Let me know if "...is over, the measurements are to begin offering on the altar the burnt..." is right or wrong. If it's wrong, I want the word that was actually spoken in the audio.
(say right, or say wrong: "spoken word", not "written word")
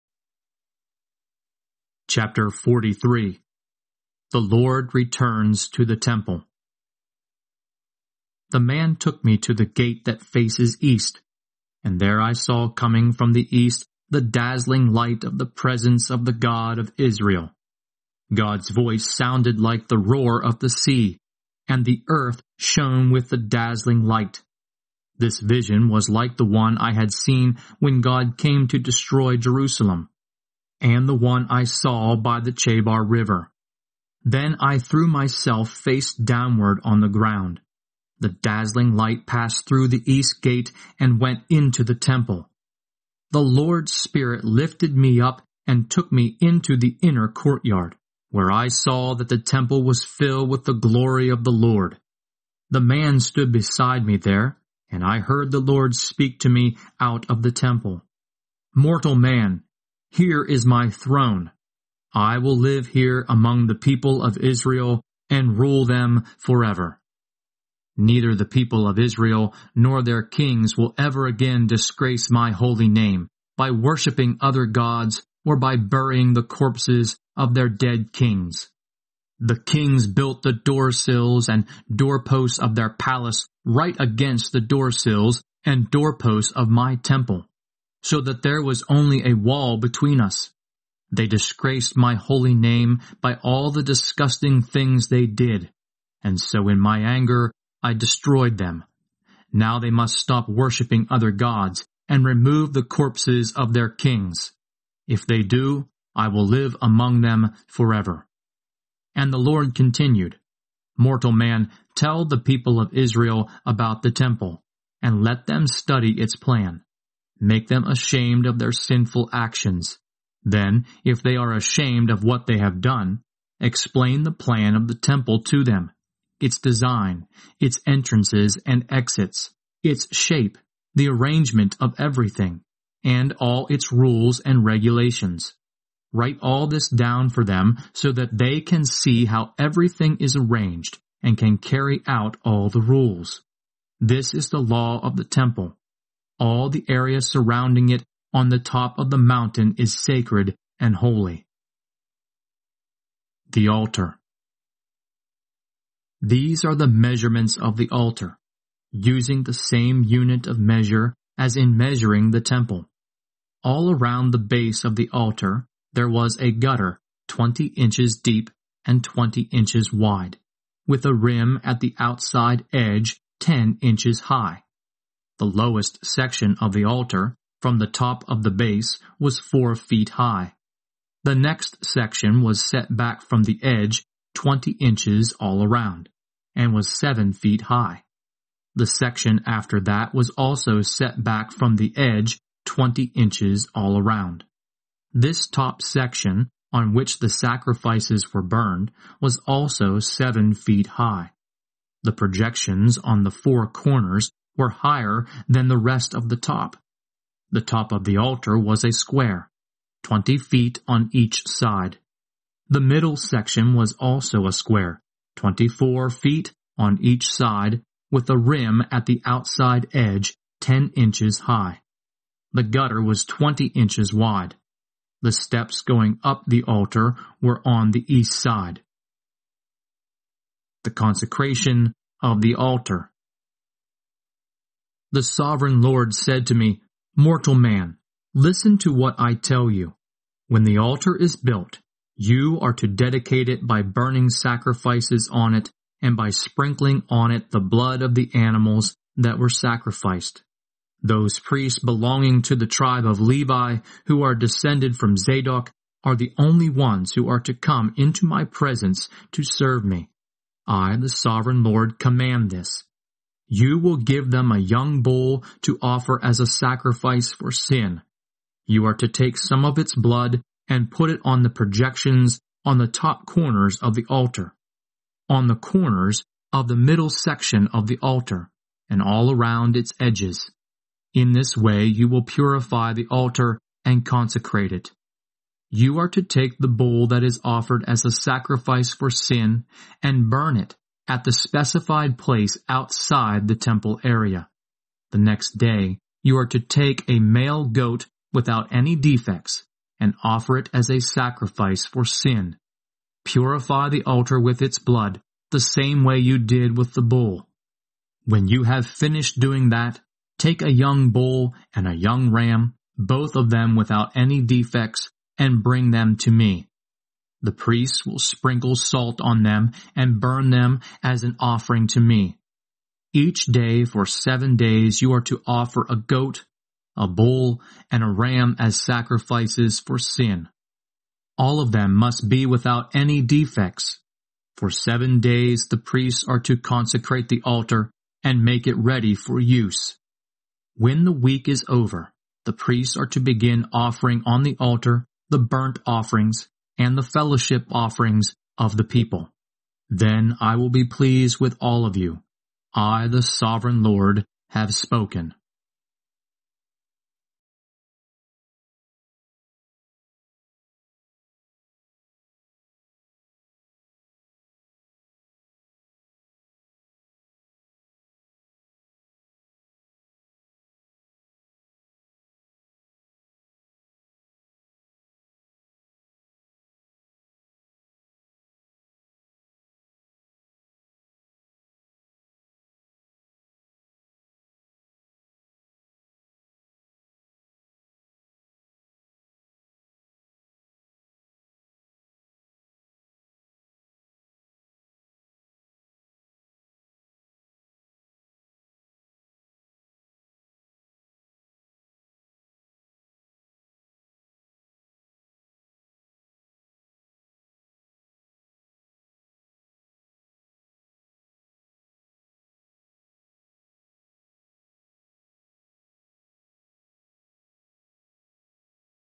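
wrong: "priests", not "measurements".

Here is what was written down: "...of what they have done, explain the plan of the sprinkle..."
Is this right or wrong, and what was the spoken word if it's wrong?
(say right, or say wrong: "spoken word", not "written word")
wrong: "temple", not "sprinkle".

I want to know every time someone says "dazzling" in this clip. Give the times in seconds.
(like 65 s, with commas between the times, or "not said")
14 s, 23 s, 38 s.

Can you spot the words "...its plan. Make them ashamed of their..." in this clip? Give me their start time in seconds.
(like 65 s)
116 s.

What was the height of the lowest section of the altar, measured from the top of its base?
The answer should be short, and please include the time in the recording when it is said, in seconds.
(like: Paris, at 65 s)
4 feet, at 179 s.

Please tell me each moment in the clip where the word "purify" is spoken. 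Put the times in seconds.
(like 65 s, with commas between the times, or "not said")
282 s, 303 s.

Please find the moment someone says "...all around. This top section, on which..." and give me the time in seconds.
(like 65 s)
193 s.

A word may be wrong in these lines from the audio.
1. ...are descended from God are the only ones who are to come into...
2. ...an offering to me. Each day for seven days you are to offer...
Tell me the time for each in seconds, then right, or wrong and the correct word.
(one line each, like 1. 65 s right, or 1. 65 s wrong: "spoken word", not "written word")
1. 254 s wrong: "Zadok", not "God"
2. 321 s right.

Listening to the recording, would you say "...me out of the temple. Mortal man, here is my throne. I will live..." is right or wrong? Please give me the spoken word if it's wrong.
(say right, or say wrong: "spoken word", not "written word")
right.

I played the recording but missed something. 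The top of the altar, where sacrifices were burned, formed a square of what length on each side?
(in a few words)
20 feet.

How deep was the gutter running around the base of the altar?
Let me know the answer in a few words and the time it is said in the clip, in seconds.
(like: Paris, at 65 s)
20 inches, at 167 s.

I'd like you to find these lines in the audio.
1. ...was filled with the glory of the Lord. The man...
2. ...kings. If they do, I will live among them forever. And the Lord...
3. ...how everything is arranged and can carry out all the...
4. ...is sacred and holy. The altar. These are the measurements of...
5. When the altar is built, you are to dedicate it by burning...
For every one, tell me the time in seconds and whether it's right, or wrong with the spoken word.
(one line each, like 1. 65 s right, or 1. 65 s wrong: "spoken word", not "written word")
1. 49 s right
2. 103 s right
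3. 139 s right
4. 149 s right
5. 240 s right.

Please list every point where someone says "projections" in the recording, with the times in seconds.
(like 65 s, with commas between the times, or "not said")
202 s, 271 s.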